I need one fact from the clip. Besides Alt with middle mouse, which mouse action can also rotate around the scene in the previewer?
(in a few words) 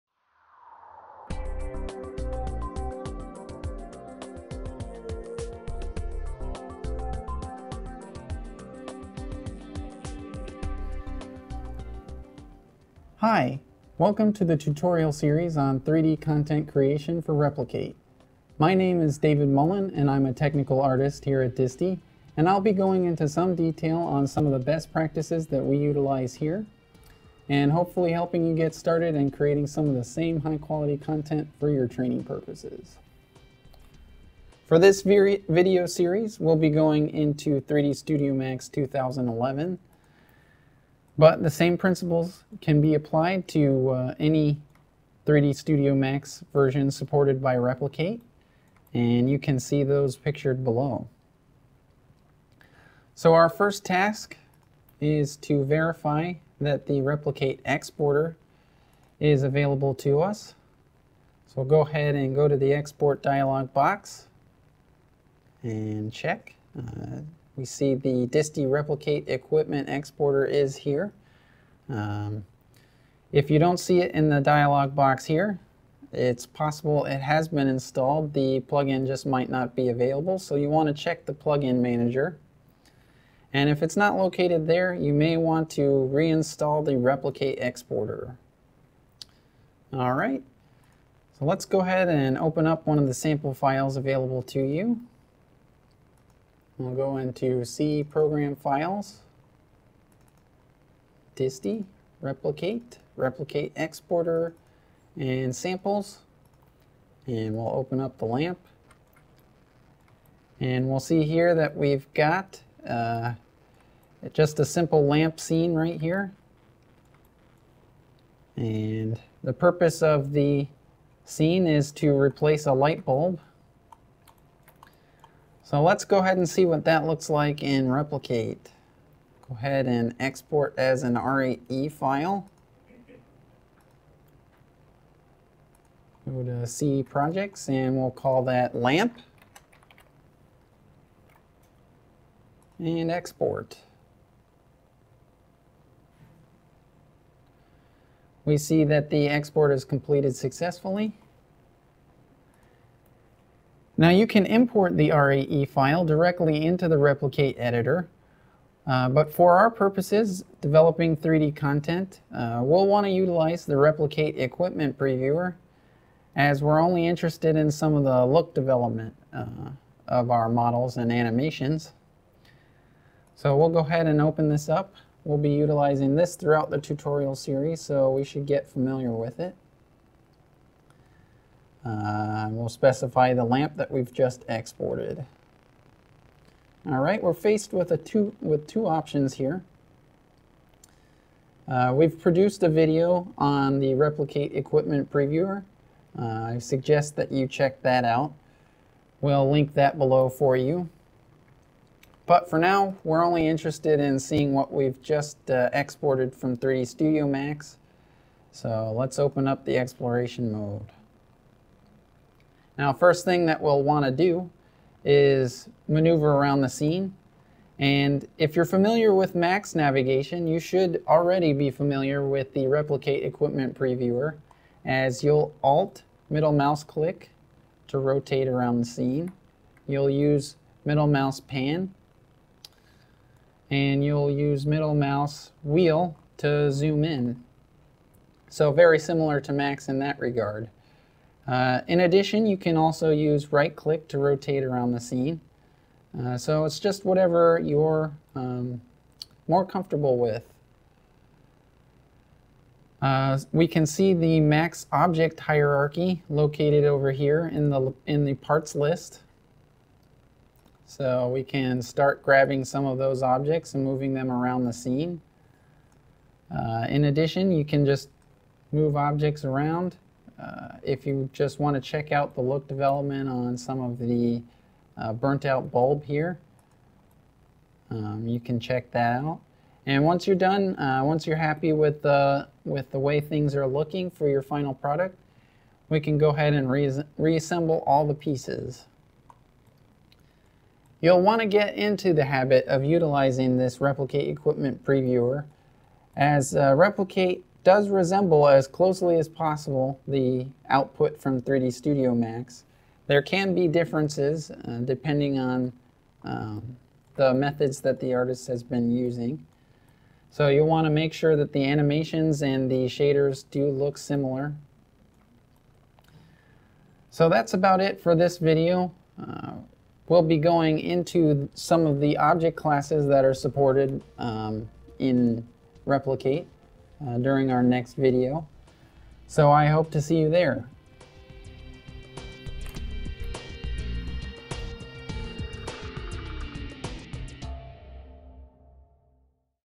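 right click.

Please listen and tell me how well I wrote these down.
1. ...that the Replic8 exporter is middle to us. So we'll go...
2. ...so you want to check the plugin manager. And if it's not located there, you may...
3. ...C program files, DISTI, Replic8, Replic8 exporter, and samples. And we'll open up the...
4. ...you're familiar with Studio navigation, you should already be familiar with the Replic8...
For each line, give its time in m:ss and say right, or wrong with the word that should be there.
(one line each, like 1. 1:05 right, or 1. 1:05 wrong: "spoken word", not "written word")
1. 0:56 wrong: "available", not "middle"
2. 1:20 right
3. 1:37 right
4. 3:38 wrong: "Max", not "Studio".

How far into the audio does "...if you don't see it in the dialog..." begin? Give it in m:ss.
1:13.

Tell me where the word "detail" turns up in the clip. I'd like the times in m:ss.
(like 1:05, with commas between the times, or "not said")
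0:23.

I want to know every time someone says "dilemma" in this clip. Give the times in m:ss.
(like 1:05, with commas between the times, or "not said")
not said.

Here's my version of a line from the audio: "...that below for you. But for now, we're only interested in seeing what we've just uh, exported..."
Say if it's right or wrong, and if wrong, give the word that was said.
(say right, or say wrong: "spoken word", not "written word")
right.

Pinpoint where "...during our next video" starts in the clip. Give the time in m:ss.
5:27.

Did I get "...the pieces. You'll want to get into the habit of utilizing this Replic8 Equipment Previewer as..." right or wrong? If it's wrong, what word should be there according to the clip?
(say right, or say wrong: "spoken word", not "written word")
right.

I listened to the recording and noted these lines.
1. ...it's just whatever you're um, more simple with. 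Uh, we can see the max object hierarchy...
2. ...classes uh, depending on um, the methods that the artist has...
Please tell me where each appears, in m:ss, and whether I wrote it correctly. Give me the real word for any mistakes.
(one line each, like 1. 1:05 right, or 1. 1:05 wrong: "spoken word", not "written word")
1. 4:06 wrong: "comfortable", not "simple"
2. 5:03 wrong: "differences", not "classes".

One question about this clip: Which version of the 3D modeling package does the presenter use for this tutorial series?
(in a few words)
3D Studio Max 2011.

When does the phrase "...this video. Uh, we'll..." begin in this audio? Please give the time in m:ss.
5:18.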